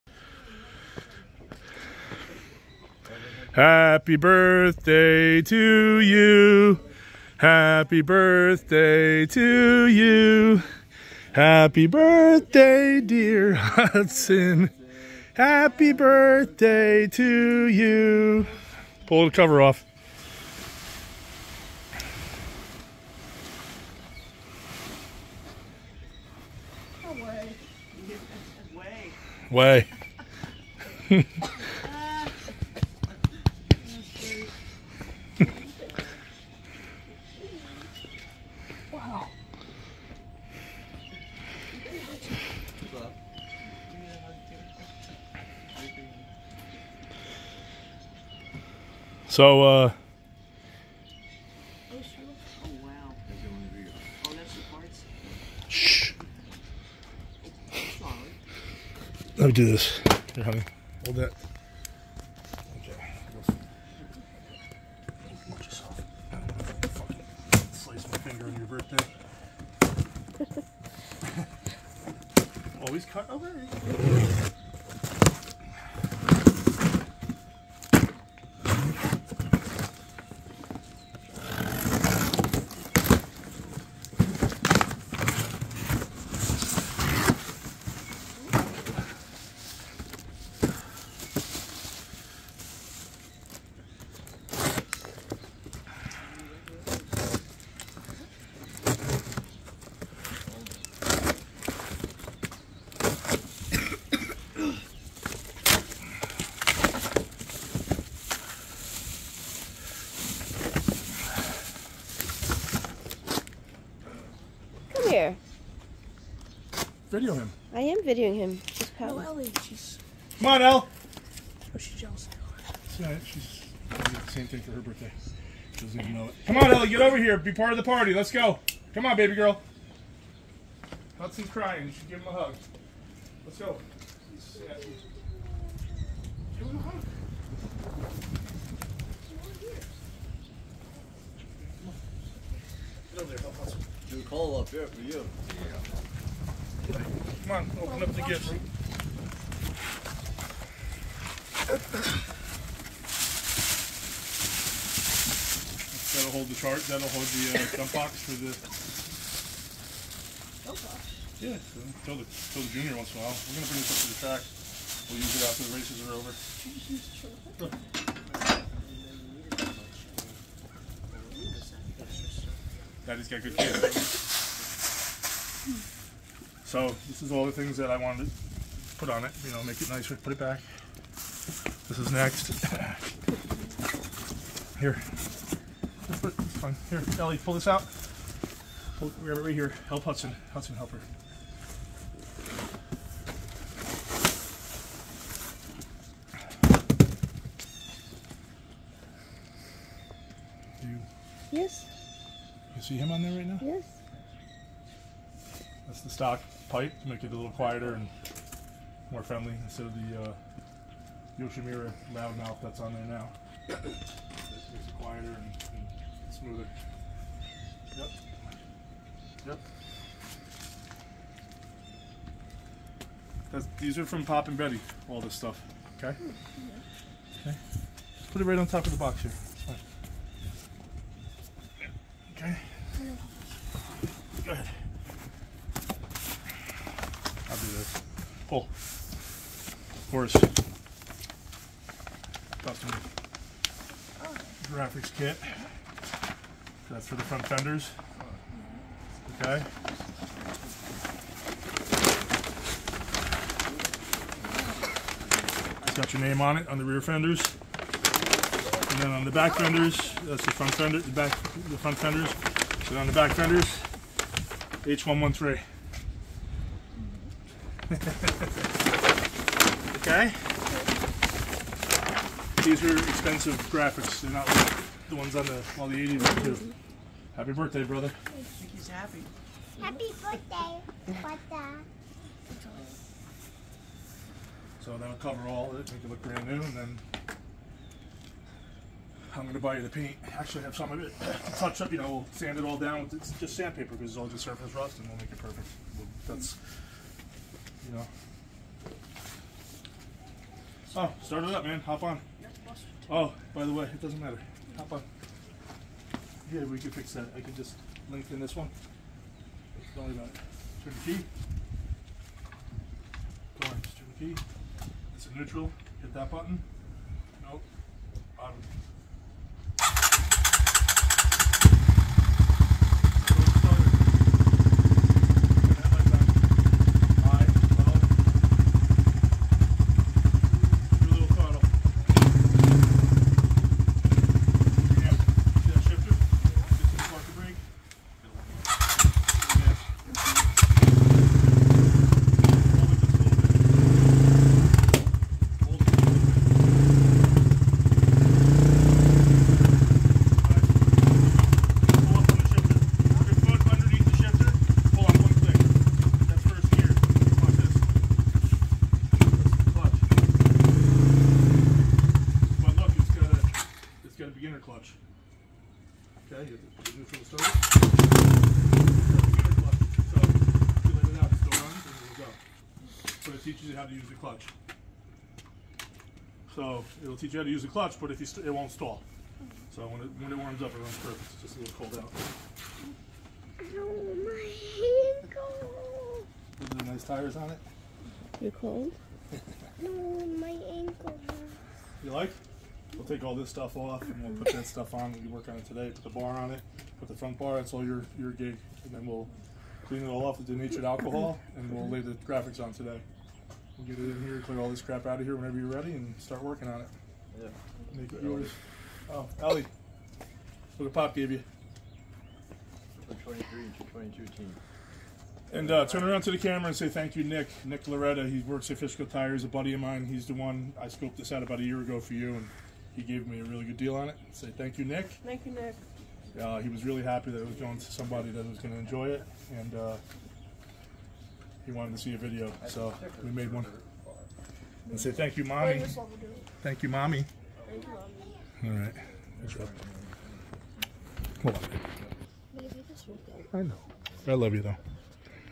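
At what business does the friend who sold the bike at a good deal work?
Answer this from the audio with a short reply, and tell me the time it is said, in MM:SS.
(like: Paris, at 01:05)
Fiscal Tires, at 06:58.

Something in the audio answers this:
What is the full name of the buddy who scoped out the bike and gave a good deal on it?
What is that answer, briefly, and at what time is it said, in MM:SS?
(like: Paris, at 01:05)
Nick Loretta, at 06:57.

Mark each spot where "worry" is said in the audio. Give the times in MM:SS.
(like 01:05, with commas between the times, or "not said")
05:10.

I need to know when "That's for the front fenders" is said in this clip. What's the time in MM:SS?
04:06.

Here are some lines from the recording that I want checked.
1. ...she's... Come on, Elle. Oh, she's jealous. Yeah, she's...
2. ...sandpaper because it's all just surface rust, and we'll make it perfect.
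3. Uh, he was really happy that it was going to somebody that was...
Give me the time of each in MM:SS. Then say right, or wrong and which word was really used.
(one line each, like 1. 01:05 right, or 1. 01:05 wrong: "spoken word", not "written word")
1. 01:59 right
2. 04:53 right
3. 07:06 right.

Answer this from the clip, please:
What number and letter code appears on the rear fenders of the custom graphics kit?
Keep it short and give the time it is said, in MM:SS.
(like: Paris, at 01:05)
H113, at 04:24.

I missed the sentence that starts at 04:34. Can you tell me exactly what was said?
They're not like the ones on the, well, the 80s too.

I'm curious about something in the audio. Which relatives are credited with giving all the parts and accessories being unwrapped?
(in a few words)
Pop and Betty.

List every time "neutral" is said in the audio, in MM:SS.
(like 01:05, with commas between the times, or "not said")
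05:15, 06:06.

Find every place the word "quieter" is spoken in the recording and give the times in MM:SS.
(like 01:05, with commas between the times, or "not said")
03:27, 03:35.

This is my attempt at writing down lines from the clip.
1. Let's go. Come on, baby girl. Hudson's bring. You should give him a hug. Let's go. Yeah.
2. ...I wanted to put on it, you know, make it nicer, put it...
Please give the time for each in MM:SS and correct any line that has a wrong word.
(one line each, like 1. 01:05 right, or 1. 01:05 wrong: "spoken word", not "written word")
1. 02:08 wrong: "crying", not "bring"
2. 02:57 right.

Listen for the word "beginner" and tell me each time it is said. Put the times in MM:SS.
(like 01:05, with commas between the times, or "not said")
06:04.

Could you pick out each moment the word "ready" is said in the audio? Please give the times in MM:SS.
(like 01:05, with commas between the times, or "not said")
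06:45.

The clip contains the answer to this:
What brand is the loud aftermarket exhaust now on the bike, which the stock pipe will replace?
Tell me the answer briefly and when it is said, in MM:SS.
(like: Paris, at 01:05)
Yoshimura, at 03:31.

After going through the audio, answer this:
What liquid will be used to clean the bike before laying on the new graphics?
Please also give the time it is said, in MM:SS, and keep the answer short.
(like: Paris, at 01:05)
Denatured alcohol, at 06:40.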